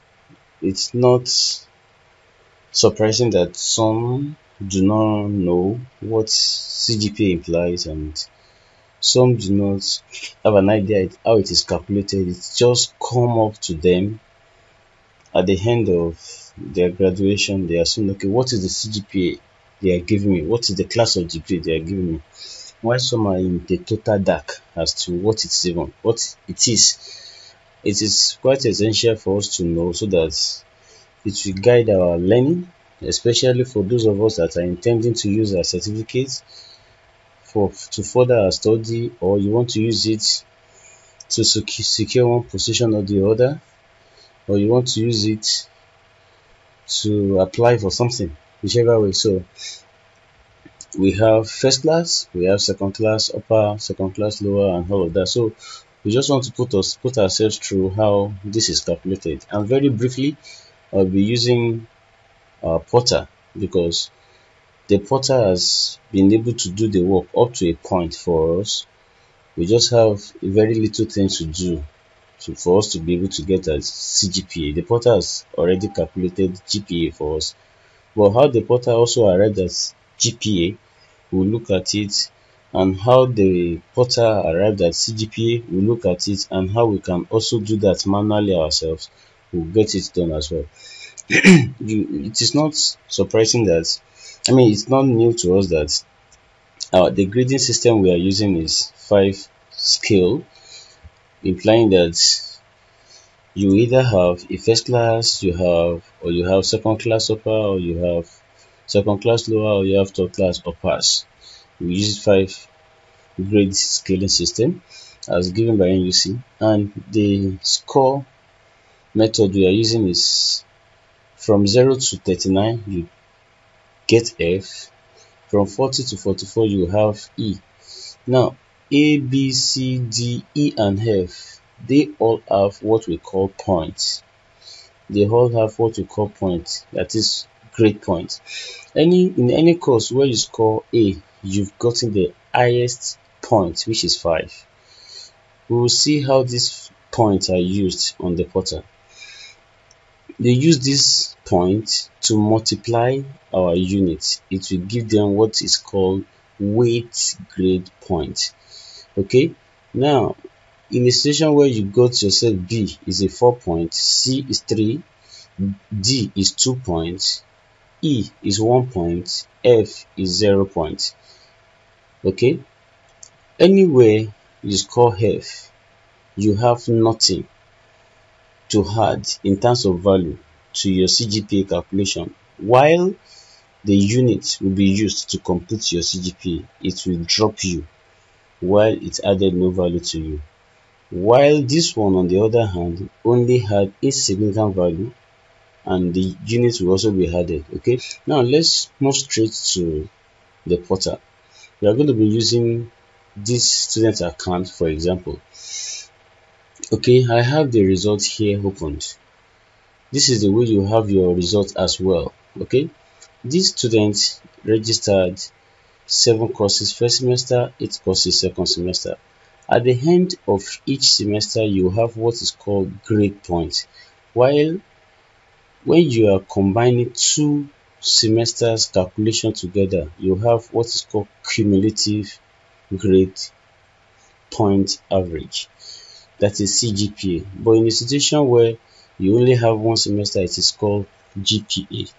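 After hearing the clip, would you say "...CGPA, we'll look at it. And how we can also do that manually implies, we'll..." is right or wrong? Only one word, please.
wrong.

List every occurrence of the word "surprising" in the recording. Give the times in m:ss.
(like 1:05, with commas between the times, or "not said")
0:02, 1:33.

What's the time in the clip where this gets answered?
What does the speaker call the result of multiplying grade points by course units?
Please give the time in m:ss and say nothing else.
2:36.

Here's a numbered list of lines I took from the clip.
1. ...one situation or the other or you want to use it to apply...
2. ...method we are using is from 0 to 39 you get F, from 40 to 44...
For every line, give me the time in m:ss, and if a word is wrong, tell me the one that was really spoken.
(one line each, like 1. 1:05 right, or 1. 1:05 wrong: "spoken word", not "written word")
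1. 0:42 wrong: "position", not "situation"
2. 1:59 right.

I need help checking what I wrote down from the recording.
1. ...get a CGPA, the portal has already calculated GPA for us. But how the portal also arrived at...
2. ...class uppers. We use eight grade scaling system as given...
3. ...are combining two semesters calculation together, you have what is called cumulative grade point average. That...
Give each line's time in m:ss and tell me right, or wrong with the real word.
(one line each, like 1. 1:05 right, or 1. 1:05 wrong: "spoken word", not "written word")
1. 1:13 right
2. 1:50 wrong: "five", not "eight"
3. 3:46 right.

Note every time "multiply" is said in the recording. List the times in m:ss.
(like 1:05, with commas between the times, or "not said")
2:32.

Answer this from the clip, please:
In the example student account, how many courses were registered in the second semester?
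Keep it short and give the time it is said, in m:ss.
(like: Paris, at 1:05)
8, at 3:37.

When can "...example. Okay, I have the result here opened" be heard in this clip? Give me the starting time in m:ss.
3:24.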